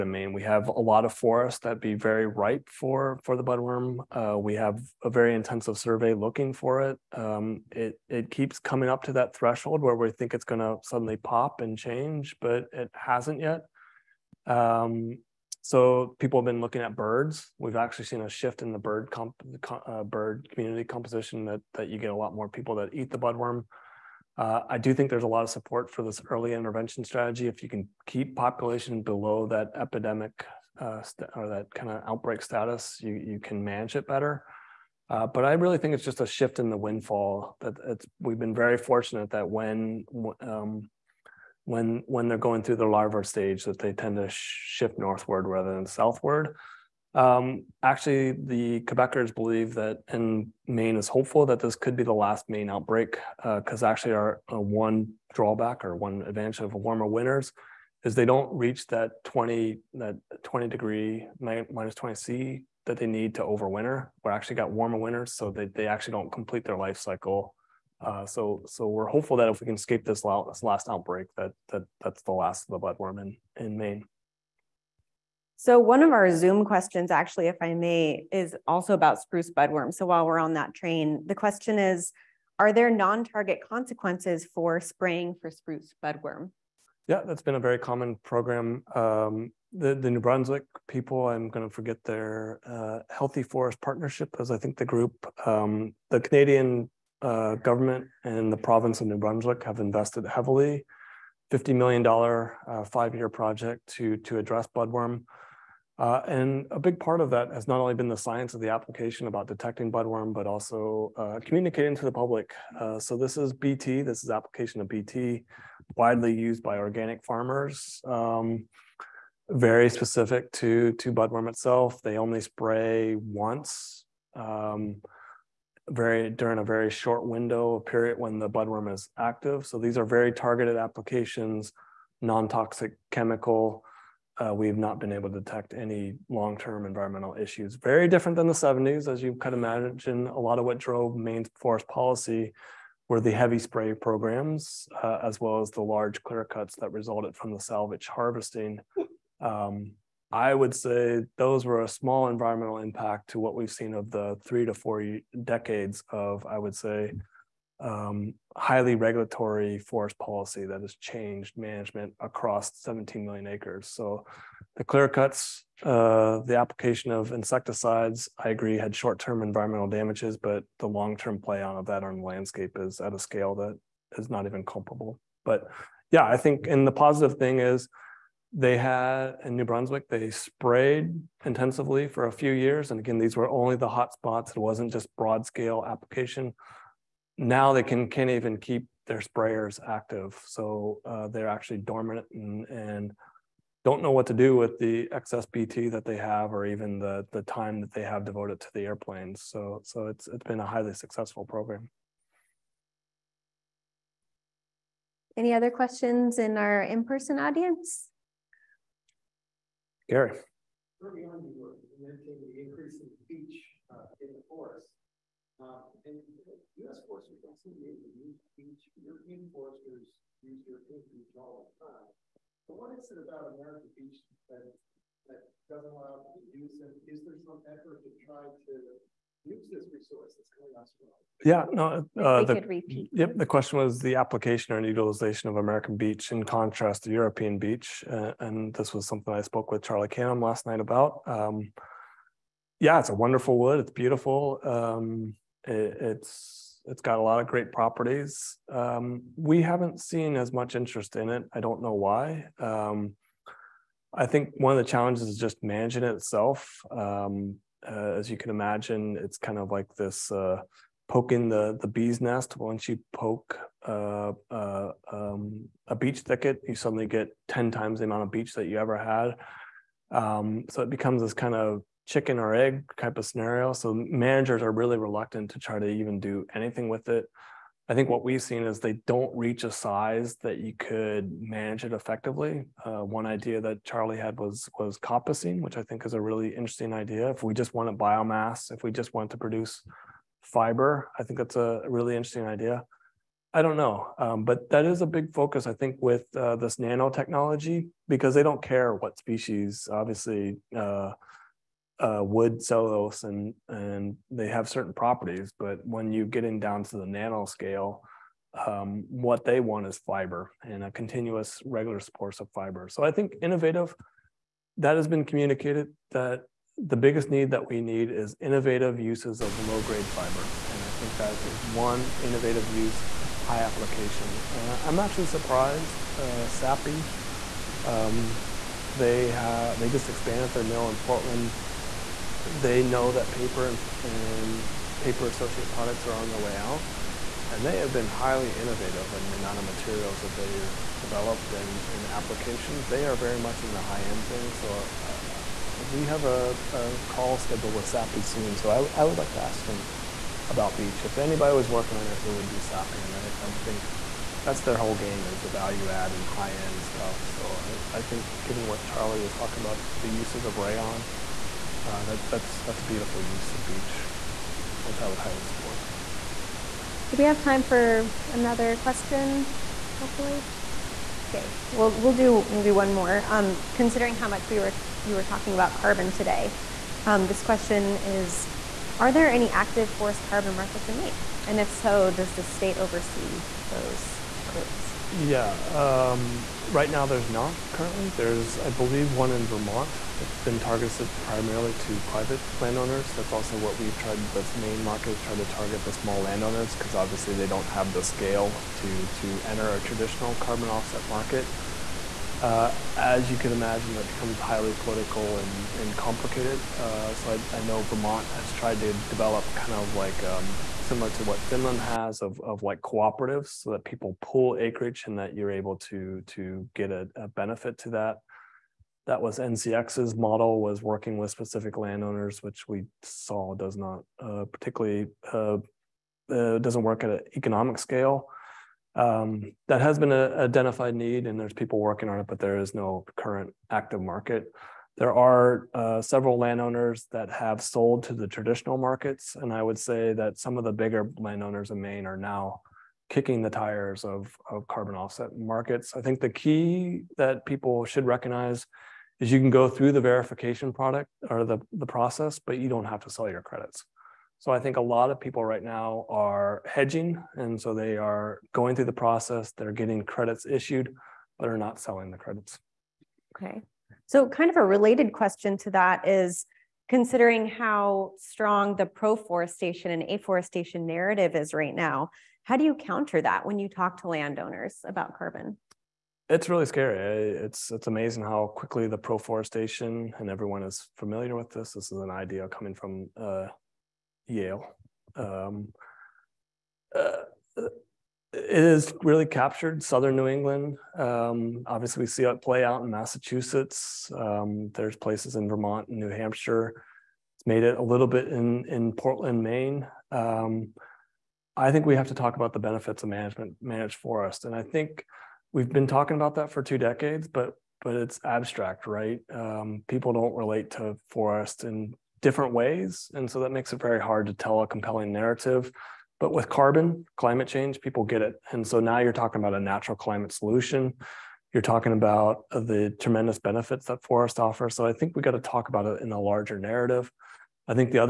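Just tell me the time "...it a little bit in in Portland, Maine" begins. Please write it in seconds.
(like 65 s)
497 s.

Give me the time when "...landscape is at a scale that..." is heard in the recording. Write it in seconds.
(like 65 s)
172 s.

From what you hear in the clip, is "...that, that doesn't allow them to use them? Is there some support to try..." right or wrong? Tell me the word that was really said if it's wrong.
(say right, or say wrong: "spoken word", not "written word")
wrong: "effort", not "support".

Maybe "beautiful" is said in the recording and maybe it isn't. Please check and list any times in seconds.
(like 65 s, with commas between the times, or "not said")
243 s, 362 s.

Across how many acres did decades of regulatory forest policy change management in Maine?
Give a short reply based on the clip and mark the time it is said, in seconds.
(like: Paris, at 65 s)
17 million acres, at 162 s.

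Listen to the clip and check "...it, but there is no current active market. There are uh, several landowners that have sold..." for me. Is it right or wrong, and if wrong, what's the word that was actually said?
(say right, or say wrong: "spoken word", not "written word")
right.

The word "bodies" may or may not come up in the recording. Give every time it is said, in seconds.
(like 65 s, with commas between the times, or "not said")
not said.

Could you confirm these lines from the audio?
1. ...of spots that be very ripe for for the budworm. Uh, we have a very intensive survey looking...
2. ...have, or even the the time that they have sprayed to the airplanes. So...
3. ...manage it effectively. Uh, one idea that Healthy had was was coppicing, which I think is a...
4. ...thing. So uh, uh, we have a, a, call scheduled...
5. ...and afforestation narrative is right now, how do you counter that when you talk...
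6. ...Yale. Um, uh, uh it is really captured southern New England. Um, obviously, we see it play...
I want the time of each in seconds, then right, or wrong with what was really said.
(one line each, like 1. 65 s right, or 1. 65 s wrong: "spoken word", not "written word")
1. 1 s wrong: "forests", not "spots"
2. 196 s wrong: "devoted", not "sprayed"
3. 281 s wrong: "Charlie", not "Healthy"
4. 344 s right
5. 469 s right
6. 484 s right.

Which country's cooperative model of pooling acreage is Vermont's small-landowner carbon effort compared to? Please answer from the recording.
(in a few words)
Finland.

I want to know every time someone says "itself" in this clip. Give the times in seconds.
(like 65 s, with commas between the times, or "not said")
121 s, 256 s.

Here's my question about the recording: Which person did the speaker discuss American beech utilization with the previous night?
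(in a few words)
Charlie Canham.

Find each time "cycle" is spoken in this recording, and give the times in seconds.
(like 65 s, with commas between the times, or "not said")
66 s.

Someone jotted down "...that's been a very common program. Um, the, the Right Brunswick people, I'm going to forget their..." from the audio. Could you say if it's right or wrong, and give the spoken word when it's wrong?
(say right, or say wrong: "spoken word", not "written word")
wrong: "New", not "Right".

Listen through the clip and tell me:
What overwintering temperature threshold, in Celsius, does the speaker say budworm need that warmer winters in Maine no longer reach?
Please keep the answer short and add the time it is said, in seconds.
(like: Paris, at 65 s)
-20 C, at 61 s.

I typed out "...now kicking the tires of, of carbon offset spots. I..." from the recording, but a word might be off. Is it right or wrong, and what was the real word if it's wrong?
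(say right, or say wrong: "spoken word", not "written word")
wrong: "markets", not "spots".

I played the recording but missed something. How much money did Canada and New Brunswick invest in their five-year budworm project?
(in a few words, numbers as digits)
$50 million.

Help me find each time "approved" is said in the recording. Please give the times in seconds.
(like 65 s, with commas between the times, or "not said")
not said.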